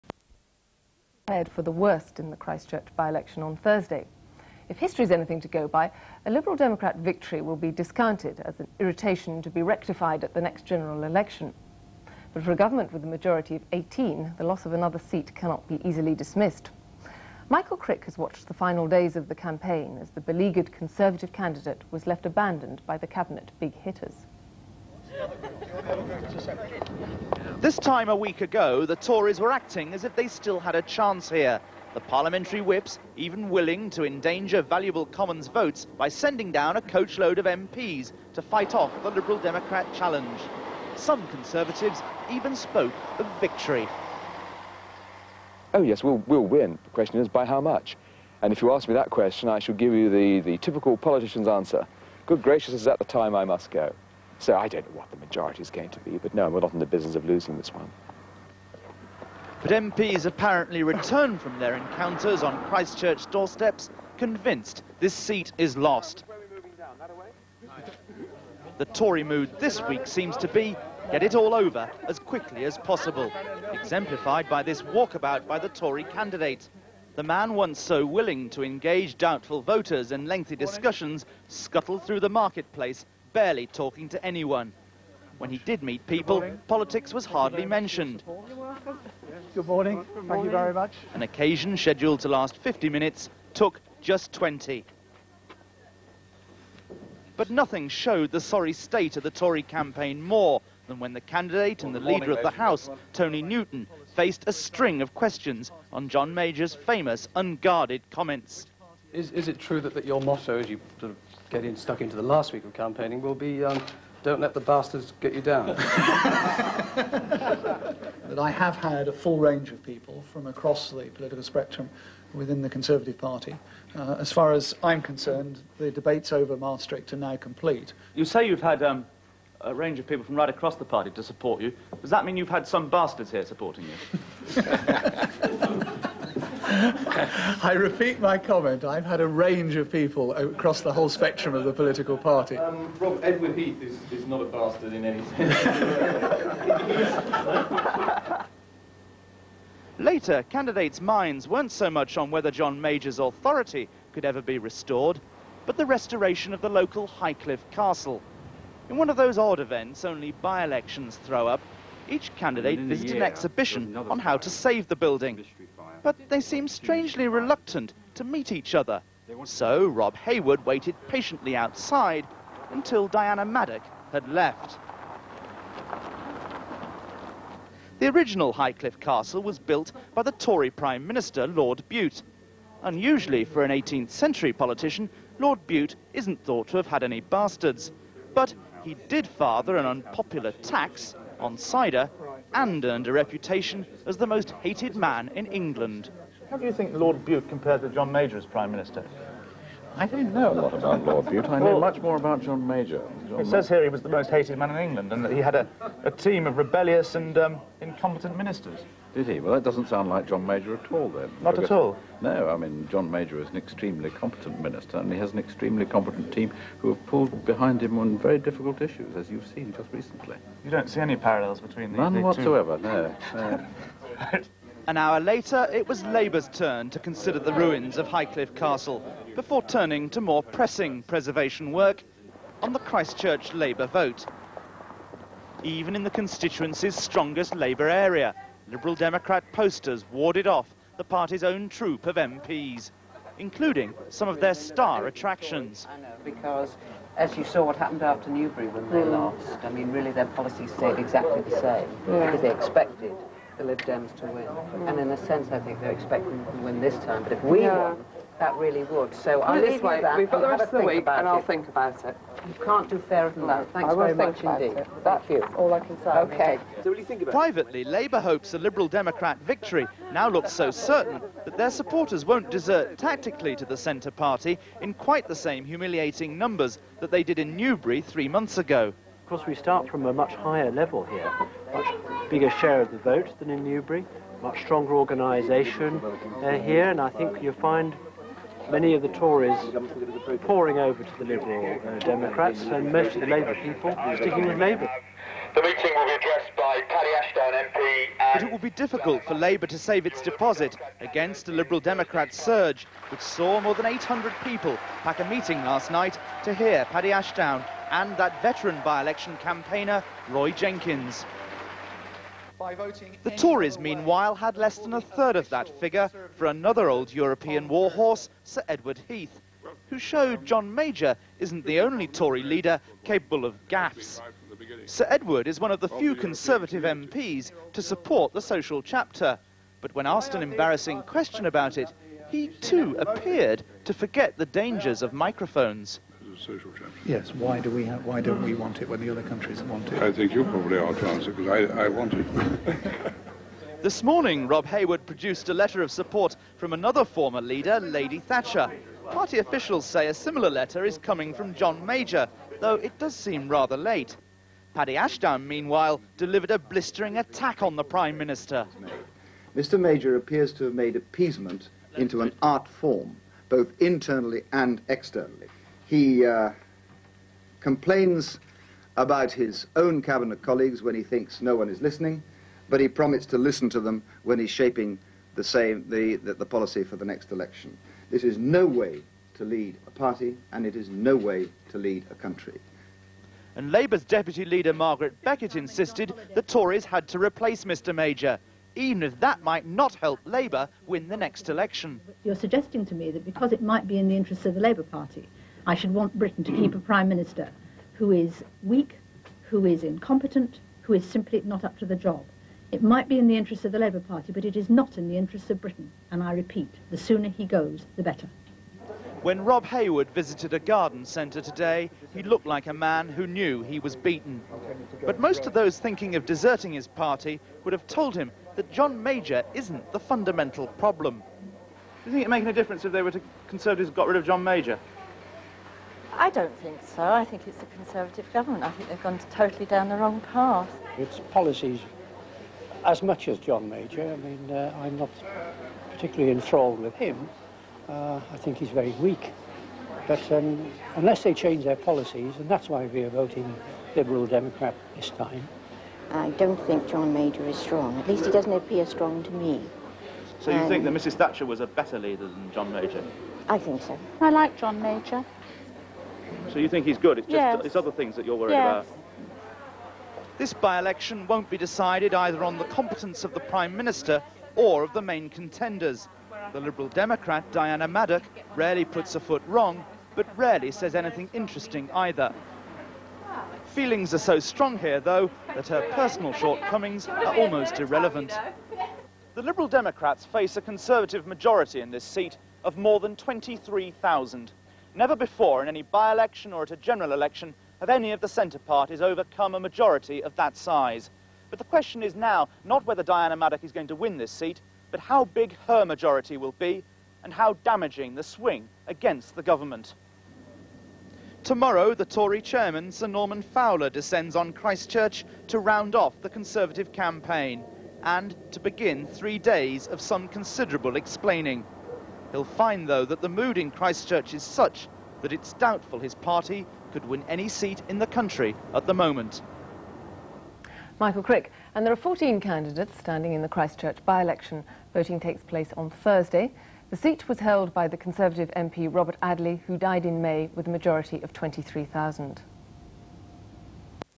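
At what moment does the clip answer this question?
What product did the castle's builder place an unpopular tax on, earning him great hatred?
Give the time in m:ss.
3:11.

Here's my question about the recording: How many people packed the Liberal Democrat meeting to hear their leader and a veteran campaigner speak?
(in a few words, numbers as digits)
More than 800.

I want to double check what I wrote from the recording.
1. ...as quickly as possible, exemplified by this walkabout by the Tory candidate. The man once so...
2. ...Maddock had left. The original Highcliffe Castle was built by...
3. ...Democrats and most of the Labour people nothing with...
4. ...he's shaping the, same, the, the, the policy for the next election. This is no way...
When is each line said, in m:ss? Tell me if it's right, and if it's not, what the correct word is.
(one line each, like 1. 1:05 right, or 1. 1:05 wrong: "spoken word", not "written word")
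1. 1:12 right
2. 2:53 right
3. 4:51 wrong: "sticking", not "nothing"
4. 6:14 right.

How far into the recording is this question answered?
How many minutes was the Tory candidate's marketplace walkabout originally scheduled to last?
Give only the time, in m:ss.
1:32.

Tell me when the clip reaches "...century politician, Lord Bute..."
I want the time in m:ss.
3:04.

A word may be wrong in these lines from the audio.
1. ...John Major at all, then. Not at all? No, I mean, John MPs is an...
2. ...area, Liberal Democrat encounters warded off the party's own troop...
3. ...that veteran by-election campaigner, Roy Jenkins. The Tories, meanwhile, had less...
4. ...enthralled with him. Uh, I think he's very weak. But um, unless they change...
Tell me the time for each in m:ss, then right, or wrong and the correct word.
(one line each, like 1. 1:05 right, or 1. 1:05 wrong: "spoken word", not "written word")
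1. 3:30 wrong: "Major", not "MPs"
2. 3:57 wrong: "posters", not "encounters"
3. 5:08 right
4. 7:16 right.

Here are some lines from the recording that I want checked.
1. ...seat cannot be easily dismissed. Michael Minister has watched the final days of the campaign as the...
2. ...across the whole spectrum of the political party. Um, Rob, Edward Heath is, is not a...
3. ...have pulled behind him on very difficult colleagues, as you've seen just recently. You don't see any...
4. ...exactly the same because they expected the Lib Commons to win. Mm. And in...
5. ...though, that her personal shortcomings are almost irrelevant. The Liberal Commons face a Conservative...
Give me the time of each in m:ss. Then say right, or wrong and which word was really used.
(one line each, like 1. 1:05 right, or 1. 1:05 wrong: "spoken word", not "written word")
1. 0:14 wrong: "Crick", not "Minister"
2. 2:20 right
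3. 3:36 wrong: "issues", not "colleagues"
4. 4:10 wrong: "Dems", not "Commons"
5. 7:54 wrong: "Democrats", not "Commons".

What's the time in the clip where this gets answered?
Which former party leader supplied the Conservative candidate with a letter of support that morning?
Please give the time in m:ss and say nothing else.
5:47.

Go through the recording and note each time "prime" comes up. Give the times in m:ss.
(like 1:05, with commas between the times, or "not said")
3:00, 3:18, 5:57, 6:36, 7:43.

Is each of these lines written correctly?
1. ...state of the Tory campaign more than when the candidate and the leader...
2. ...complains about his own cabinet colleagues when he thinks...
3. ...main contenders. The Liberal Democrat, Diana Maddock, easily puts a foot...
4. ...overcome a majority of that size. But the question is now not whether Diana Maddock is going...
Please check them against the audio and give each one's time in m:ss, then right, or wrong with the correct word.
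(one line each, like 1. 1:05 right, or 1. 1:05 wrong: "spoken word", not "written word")
1. 1:38 right
2. 6:07 right
3. 7:45 wrong: "rarely", not "easily"
4. 8:09 right.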